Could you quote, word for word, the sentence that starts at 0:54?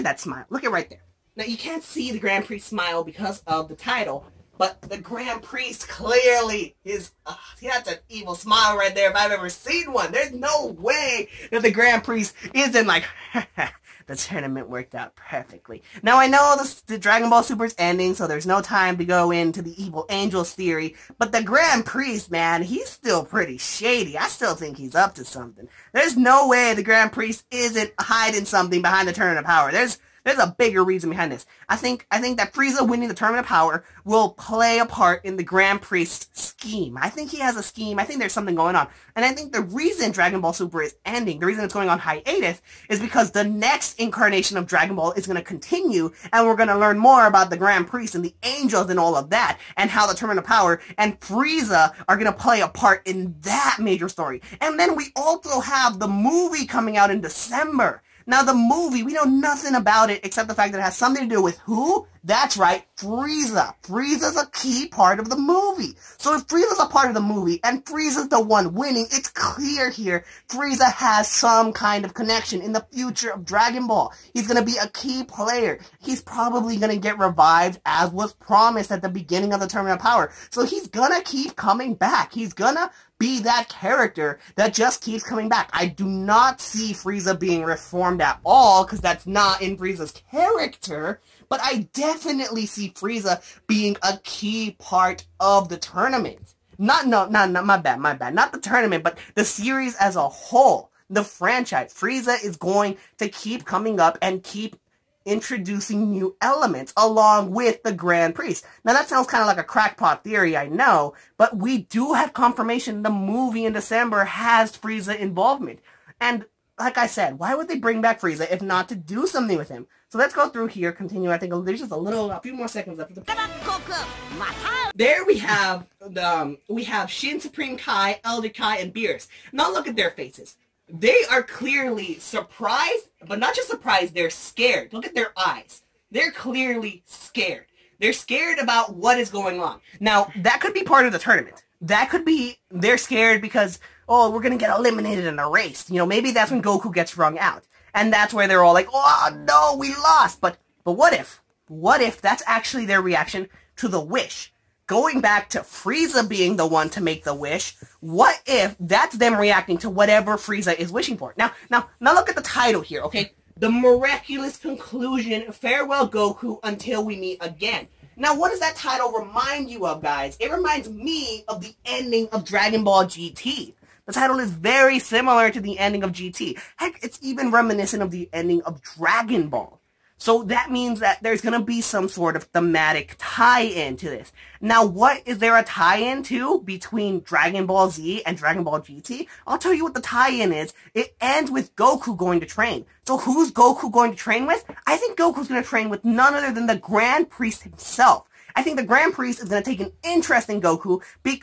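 And then we also have the movie coming out in December.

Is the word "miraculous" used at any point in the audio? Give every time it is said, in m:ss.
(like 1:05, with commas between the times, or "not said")
2:43.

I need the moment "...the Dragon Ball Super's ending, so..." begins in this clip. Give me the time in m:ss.
0:16.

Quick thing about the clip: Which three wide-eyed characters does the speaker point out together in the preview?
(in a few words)
Shin Supreme Kai, Elder Kai, and Beerus.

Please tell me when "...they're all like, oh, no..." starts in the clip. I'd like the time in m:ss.
2:28.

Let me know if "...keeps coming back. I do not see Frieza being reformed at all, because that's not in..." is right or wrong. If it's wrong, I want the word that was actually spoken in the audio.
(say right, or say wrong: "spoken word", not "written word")
right.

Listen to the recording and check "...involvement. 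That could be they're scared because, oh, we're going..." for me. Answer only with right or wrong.
wrong.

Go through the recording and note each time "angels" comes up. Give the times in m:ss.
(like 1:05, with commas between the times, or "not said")
0:20, 0:48.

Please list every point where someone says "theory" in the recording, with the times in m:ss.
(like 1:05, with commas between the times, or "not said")
0:20, 1:50.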